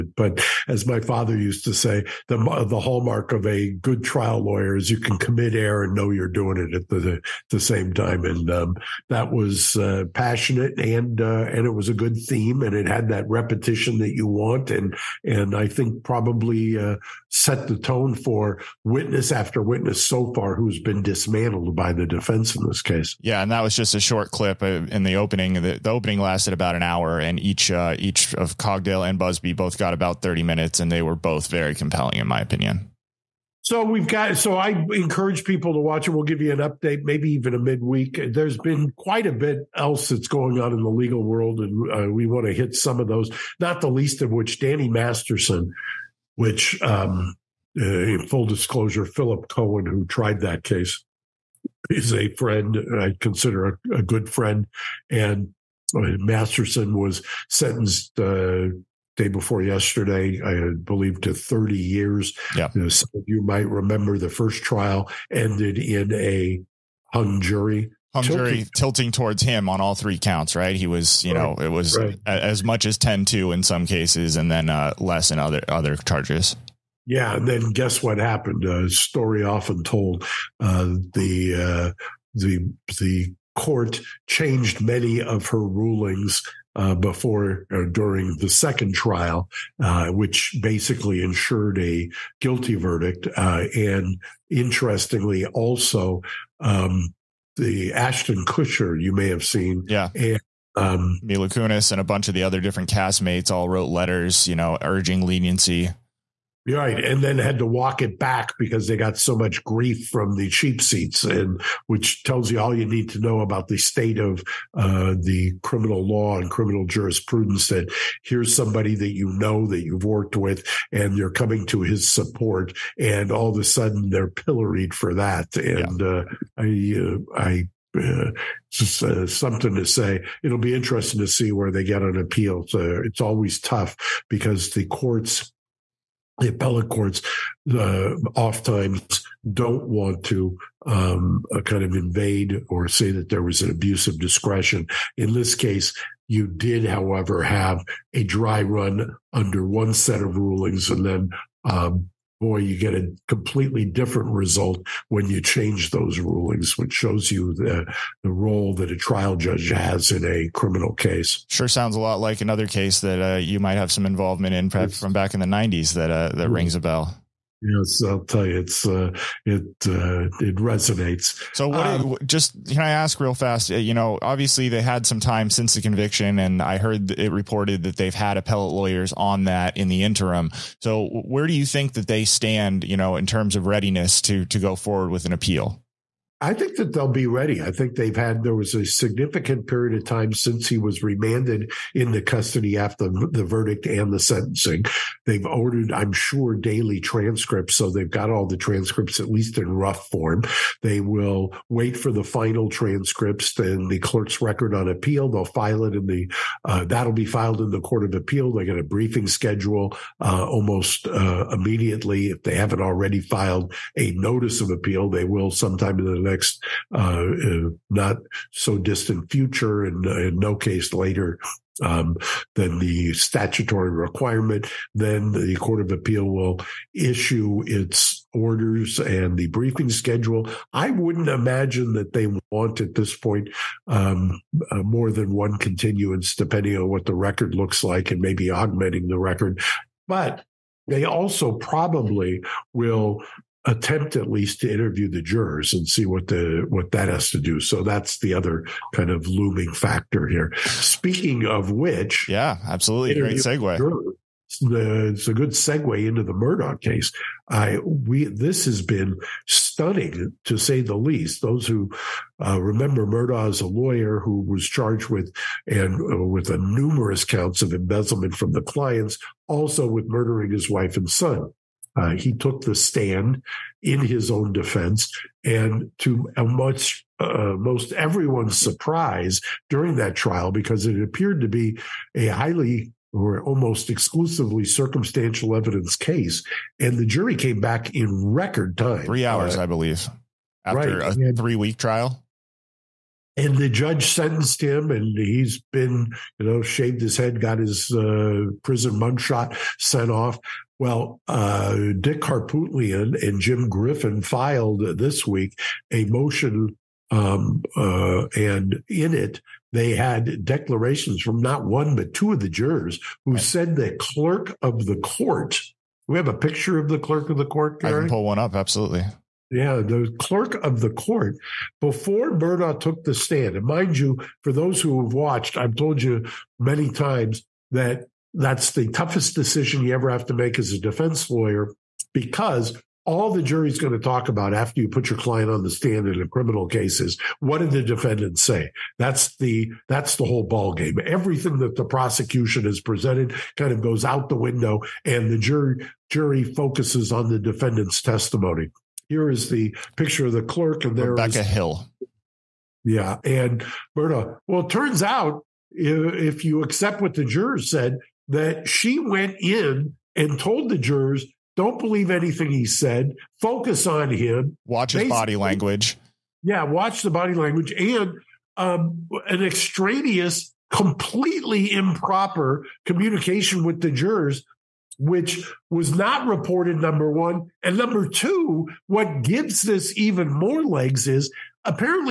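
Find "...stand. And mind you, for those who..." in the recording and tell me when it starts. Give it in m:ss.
5:23.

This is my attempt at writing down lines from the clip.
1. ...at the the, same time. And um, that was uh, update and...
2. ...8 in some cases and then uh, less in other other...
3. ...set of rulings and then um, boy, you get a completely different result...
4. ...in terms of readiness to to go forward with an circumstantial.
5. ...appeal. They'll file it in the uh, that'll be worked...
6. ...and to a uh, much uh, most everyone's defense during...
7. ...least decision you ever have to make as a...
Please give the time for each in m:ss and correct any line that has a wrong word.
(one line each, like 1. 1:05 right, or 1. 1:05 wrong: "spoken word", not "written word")
1. 0:06 wrong: "passionate", not "update"
2. 1:13 wrong: "2", not "8"
3. 2:29 right
4. 3:03 wrong: "appeal", not "circumstantial"
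5. 3:24 wrong: "filed", not "worked"
6. 4:35 wrong: "surprise", not "defense"
7. 5:28 wrong: "toughest", not "least".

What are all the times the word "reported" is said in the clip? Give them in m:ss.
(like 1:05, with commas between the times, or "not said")
2:57, 6:16.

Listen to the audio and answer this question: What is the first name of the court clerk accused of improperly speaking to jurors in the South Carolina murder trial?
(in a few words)
Rebecca.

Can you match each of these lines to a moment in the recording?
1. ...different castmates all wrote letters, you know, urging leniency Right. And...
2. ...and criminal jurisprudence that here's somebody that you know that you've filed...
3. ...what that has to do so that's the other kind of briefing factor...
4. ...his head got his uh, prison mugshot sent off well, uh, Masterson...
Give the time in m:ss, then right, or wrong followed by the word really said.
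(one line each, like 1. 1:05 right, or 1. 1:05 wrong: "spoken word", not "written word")
1. 1:42 right
2. 1:56 wrong: "worked", not "filed"
3. 4:06 wrong: "looming", not "briefing"
4. 4:57 wrong: "Dick", not "Masterson".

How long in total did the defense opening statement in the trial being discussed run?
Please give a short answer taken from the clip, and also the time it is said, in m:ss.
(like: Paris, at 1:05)
about an hour, at 0:26.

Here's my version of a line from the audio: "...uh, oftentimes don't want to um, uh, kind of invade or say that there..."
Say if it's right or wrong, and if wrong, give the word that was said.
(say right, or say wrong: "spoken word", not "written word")
right.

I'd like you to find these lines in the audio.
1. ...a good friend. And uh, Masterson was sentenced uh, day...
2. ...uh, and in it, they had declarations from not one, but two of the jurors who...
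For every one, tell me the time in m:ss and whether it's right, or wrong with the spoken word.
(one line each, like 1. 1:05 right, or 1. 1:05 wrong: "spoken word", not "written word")
1. 0:53 right
2. 5:07 right.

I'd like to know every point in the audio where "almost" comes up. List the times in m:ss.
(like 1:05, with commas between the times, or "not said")
3:30, 4:43.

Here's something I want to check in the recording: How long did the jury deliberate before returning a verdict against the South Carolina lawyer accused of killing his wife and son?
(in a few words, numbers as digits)
3 hours.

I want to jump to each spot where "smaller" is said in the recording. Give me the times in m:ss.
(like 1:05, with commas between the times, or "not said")
not said.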